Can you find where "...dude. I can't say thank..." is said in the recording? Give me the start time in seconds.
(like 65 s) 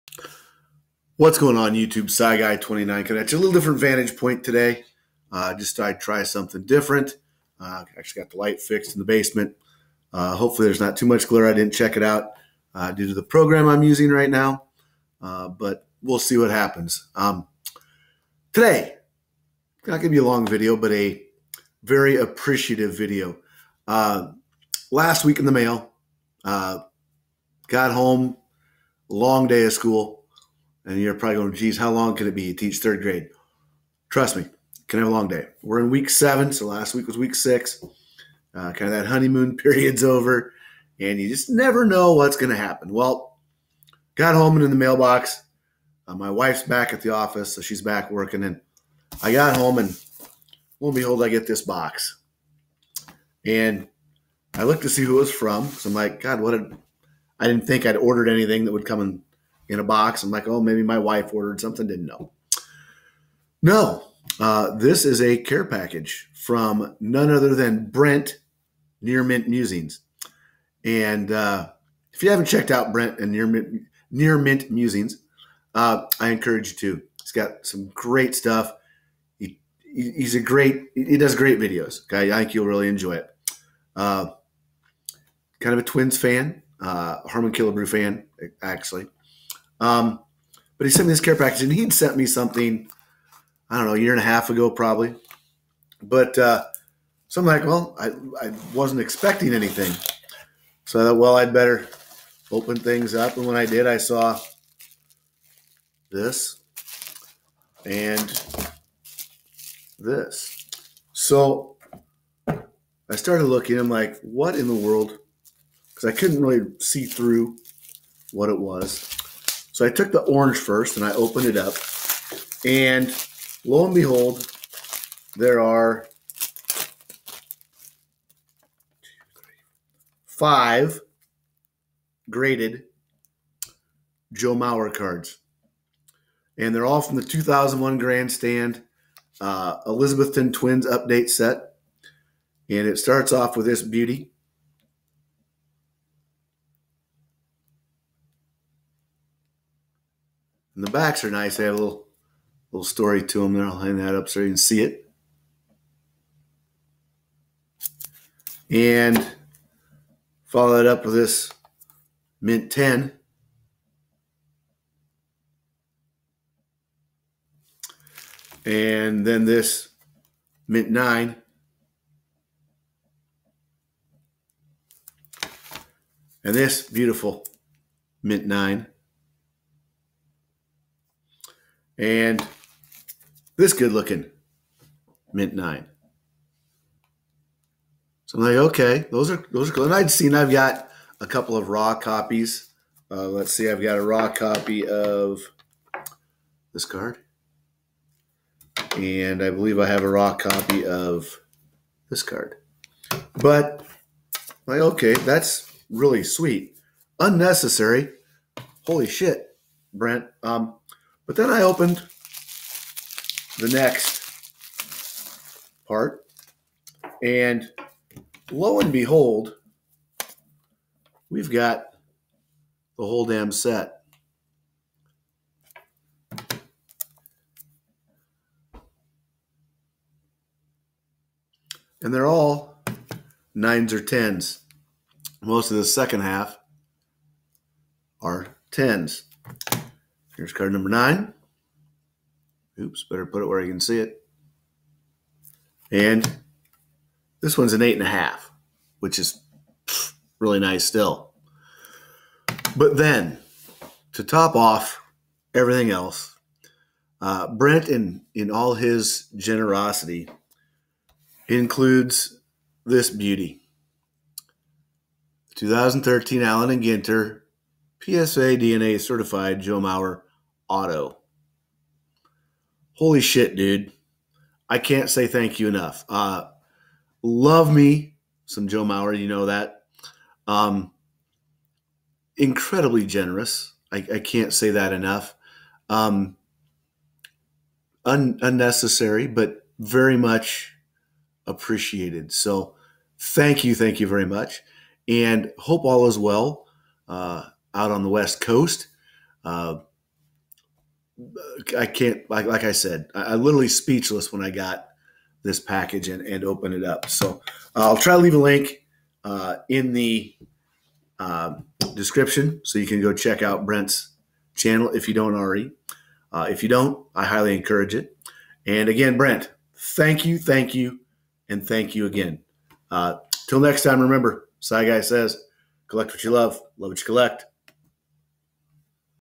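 273 s.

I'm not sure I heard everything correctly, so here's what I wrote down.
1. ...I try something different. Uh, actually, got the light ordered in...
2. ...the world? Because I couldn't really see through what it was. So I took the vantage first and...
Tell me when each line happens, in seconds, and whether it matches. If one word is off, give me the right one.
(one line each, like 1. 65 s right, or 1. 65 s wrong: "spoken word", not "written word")
1. 5 s wrong: "fixed", not "ordered"
2. 114 s wrong: "orange", not "vantage".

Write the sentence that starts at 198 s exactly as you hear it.
And I believe I have a raw copy of this card.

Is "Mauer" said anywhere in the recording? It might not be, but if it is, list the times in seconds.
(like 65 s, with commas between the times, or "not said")
134 s, 269 s, 278 s.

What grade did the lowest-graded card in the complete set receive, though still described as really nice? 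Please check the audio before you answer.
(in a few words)
8.5.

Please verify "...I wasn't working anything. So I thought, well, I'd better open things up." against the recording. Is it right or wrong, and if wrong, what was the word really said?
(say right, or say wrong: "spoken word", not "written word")
wrong: "expecting", not "working".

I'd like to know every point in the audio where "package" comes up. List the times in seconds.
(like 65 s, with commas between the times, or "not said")
65 s, 91 s, 305 s.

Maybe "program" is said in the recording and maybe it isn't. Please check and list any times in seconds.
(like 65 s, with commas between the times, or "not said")
13 s.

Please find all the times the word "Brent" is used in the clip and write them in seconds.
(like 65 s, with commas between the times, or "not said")
67 s, 72 s, 209 s, 257 s, 313 s, 319 s.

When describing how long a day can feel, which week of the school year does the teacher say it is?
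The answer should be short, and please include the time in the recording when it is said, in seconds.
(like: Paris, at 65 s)
7, at 35 s.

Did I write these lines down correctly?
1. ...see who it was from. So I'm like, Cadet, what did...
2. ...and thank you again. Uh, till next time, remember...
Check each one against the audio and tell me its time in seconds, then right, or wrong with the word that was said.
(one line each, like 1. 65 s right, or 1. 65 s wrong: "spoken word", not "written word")
1. 54 s wrong: "God", not "Cadet"
2. 321 s right.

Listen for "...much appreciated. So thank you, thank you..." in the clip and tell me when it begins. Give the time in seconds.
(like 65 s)
290 s.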